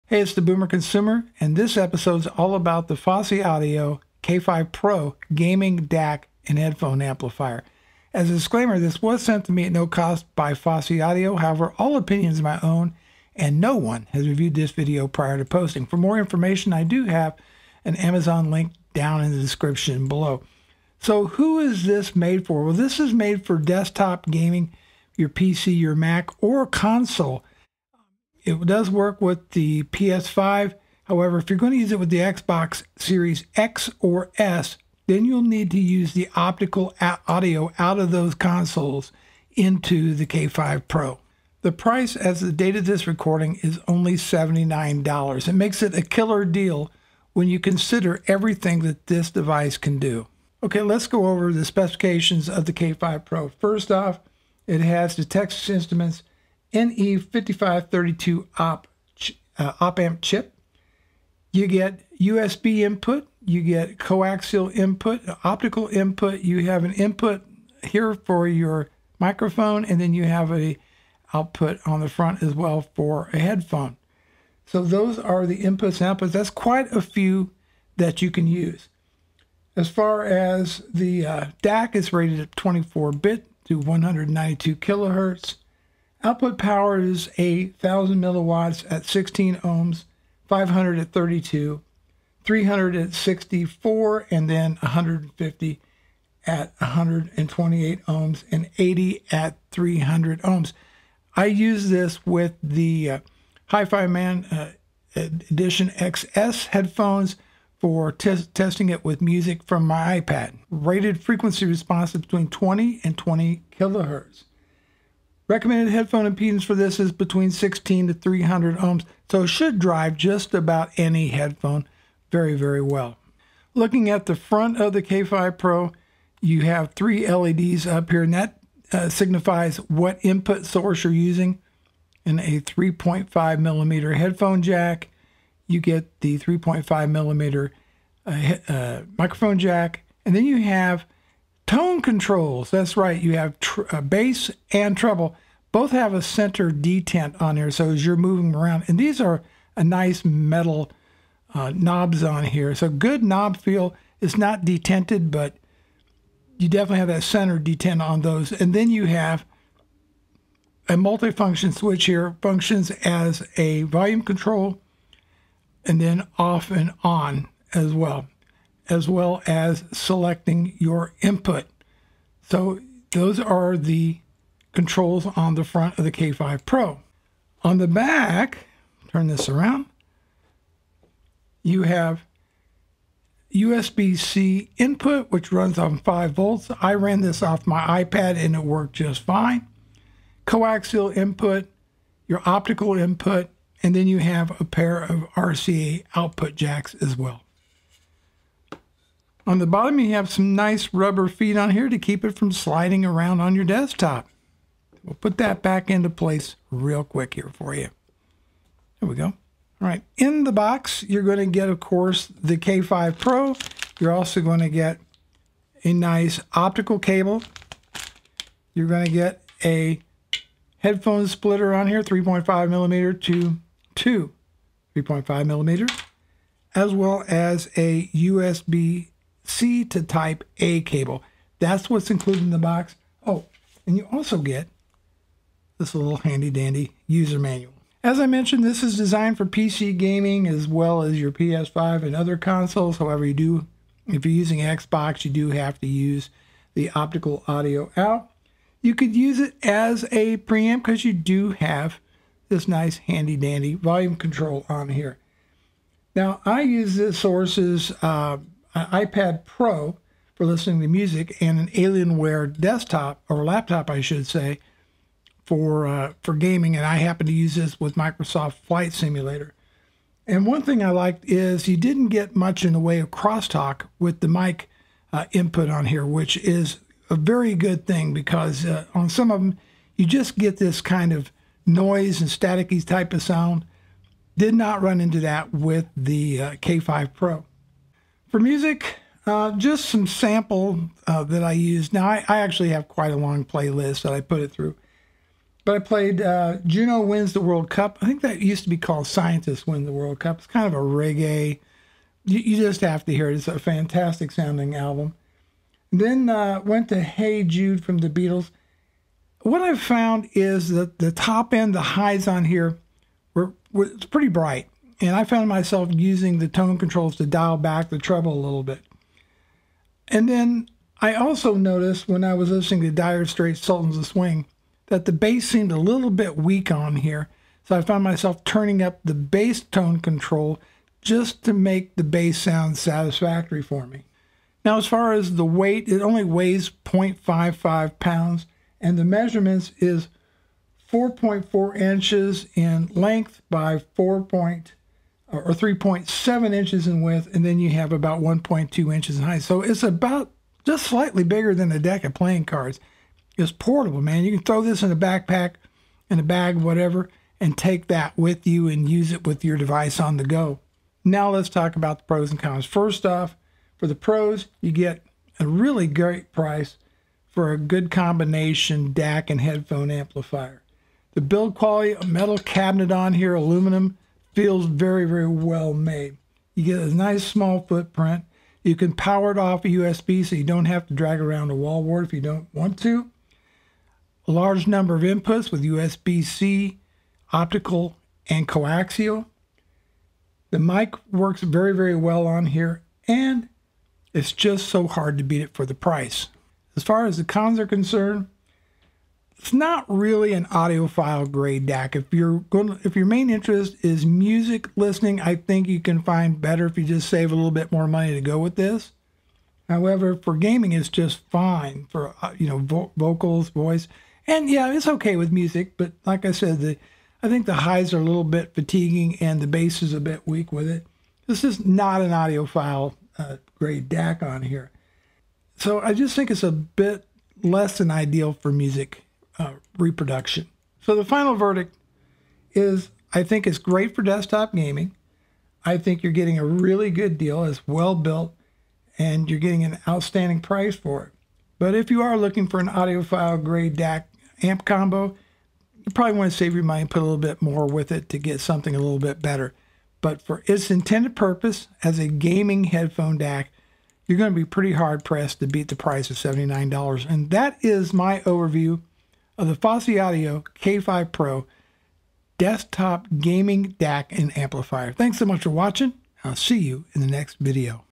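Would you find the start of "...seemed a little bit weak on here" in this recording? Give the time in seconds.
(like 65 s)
325 s.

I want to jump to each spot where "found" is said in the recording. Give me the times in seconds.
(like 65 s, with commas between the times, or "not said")
309 s, 315 s, 327 s.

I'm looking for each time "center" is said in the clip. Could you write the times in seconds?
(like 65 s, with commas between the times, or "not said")
146 s, 157 s.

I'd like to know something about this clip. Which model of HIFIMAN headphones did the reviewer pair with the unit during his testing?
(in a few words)
Edition XS.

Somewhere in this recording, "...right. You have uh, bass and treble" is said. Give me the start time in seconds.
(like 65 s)
142 s.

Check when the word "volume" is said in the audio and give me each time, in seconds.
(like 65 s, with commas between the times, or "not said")
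163 s, 253 s.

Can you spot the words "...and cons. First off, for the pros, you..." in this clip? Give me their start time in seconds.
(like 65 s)
362 s.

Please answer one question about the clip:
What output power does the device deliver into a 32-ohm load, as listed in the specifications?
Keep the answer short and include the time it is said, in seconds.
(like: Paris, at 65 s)
500 milliwatts, at 90 s.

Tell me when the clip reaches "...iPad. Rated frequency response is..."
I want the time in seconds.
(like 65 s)
110 s.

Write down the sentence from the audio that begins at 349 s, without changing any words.
So it's about just slightly bigger than a deck of playing cards.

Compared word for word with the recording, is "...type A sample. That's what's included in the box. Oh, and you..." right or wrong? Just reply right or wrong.
wrong.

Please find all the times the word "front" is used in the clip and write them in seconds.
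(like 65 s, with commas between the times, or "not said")
72 s, 124 s, 175 s.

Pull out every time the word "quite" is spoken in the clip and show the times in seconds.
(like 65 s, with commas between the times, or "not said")
76 s, 292 s.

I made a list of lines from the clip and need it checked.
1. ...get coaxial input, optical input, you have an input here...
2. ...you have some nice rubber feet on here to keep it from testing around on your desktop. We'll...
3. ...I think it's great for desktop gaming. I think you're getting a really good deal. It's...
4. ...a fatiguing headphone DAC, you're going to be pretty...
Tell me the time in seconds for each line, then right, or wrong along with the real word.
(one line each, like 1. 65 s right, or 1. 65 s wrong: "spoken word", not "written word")
1. 63 s right
2. 199 s wrong: "sliding", not "testing"
3. 433 s right
4. 451 s wrong: "gaming", not "fatiguing".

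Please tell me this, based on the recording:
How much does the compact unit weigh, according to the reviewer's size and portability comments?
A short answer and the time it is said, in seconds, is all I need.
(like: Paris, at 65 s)
0.55 pounds, at 336 s.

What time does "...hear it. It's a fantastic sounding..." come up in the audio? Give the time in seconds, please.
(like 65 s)
303 s.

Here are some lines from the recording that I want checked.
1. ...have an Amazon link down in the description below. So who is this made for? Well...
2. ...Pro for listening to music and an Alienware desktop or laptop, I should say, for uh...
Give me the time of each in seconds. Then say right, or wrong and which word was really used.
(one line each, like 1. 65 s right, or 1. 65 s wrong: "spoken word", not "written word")
1. 17 s right
2. 259 s right.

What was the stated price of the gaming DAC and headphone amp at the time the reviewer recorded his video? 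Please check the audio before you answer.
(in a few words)
$79.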